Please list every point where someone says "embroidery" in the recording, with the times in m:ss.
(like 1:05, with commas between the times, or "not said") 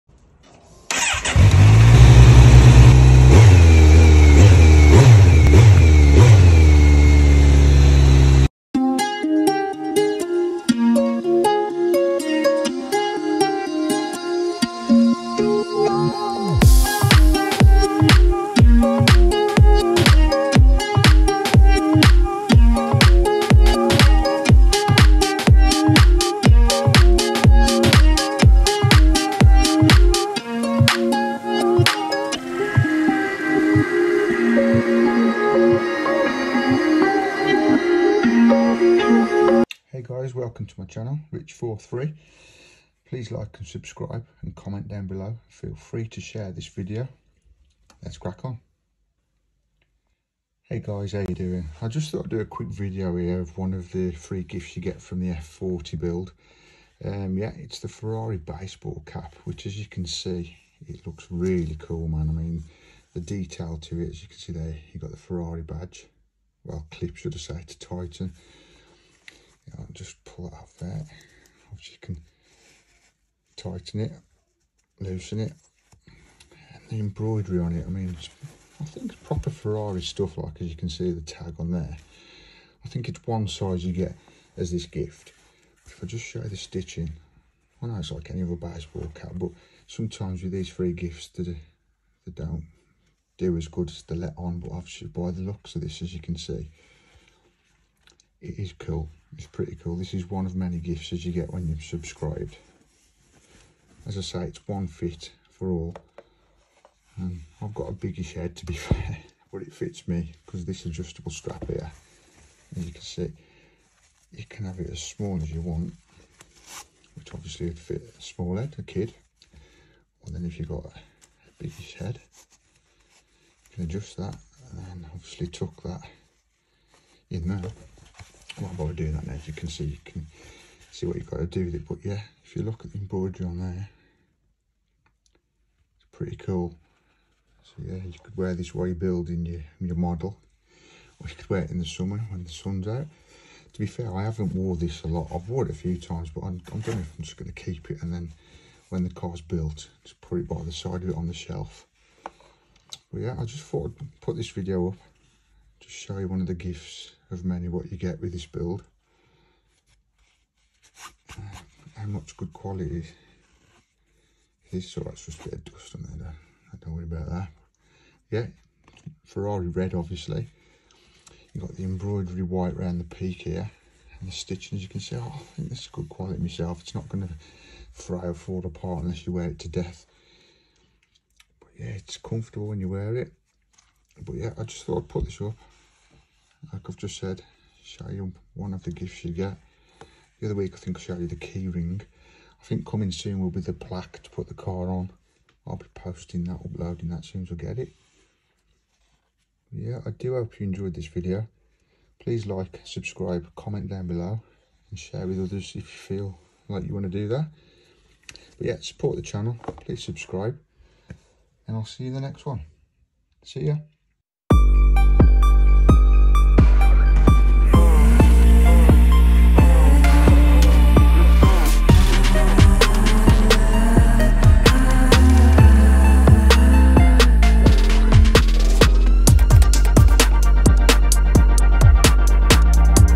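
1:16, 2:12, 2:51.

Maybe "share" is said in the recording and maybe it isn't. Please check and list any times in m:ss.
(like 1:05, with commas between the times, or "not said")
0:46, 3:24.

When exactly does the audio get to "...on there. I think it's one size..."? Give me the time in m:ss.
1:21.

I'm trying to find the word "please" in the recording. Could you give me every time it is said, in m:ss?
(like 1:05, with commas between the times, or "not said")
0:43, 3:22, 3:29.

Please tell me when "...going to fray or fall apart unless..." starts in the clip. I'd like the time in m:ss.
2:57.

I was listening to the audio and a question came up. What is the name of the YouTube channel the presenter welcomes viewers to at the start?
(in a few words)
Rich43.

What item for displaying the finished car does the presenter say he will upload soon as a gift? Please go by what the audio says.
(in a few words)
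The plaque.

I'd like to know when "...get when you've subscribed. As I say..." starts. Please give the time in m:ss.
1:41.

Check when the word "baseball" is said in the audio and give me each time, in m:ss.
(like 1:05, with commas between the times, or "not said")
0:58, 1:28.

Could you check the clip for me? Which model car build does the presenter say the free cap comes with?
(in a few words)
F40.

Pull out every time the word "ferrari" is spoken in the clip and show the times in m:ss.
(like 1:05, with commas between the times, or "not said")
0:57, 1:05, 1:19, 2:49.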